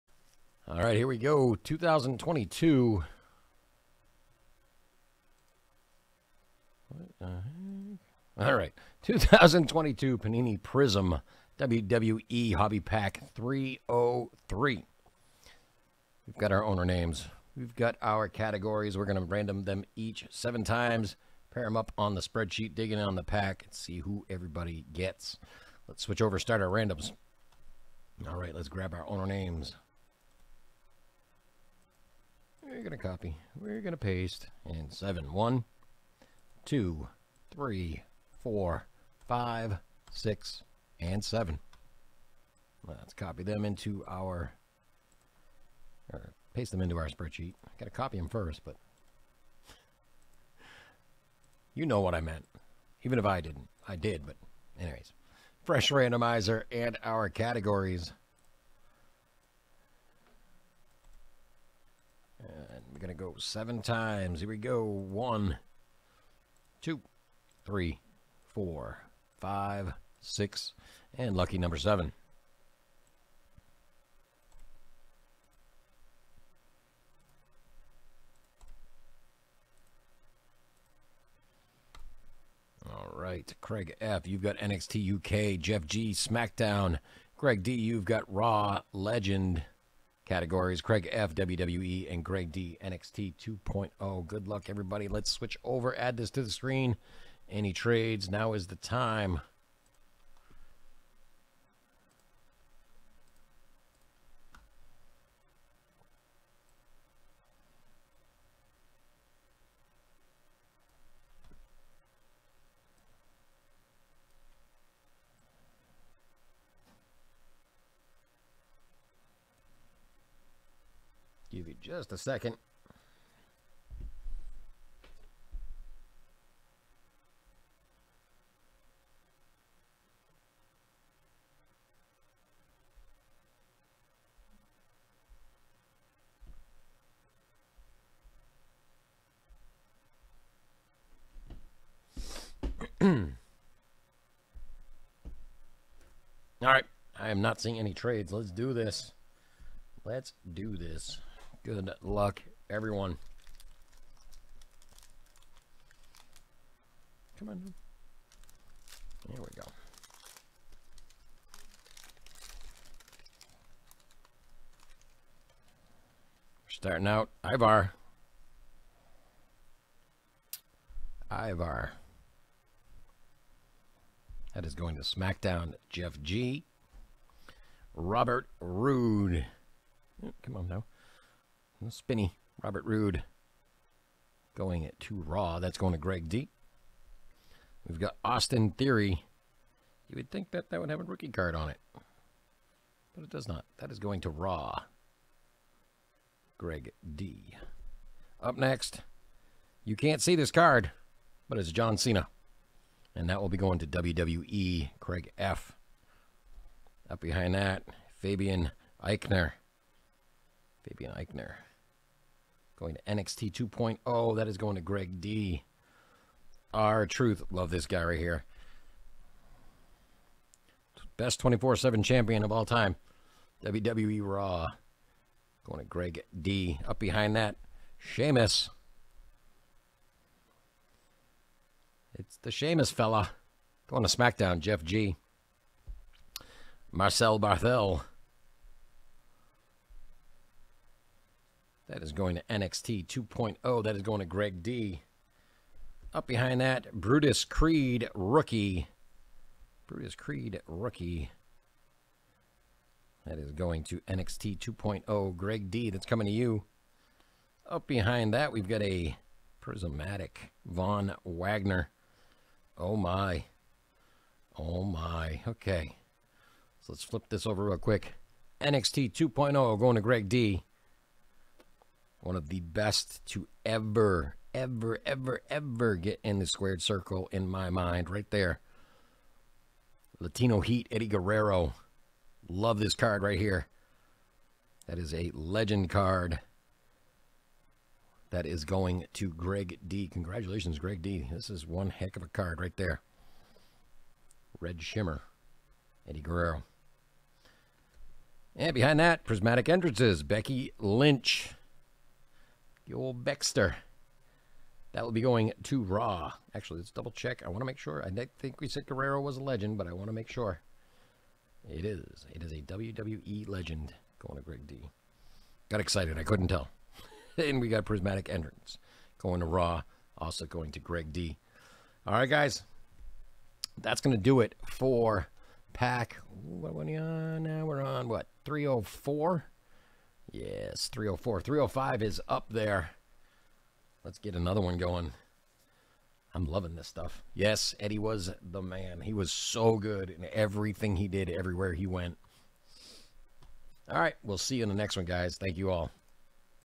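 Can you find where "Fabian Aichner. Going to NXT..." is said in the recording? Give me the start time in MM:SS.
03:30.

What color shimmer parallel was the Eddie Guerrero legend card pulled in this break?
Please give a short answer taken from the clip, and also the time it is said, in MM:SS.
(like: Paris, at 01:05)
Red, at 04:54.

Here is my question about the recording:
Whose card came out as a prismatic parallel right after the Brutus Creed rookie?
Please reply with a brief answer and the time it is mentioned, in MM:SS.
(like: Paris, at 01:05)
Von Wagner, at 04:20.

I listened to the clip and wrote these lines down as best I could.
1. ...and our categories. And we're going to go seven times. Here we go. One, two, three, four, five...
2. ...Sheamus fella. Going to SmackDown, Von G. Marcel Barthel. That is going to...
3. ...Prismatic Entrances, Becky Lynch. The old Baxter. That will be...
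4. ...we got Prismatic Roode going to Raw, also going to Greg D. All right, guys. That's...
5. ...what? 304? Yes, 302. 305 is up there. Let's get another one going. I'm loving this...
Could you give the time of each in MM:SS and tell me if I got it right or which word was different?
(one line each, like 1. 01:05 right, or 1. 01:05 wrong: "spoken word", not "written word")
1. 00:56 right
2. 03:52 wrong: "Jeff", not "Von"
3. 04:59 right
4. 05:17 wrong: "Entrance", not "Roode"
5. 05:28 wrong: "304", not "302".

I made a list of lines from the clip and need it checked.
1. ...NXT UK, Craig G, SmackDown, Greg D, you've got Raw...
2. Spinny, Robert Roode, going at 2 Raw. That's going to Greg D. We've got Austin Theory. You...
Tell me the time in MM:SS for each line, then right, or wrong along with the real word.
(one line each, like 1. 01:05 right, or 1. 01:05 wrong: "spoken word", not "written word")
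1. 01:24 wrong: "Jeff", not "Craig"
2. 03:01 right.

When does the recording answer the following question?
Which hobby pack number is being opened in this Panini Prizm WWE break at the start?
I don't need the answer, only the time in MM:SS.
00:12.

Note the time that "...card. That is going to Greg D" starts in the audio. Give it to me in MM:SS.
04:45.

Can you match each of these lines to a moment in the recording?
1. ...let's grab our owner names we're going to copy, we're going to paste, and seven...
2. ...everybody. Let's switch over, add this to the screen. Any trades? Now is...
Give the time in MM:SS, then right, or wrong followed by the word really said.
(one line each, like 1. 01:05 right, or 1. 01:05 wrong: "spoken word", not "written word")
1. 00:28 right
2. 01:34 right.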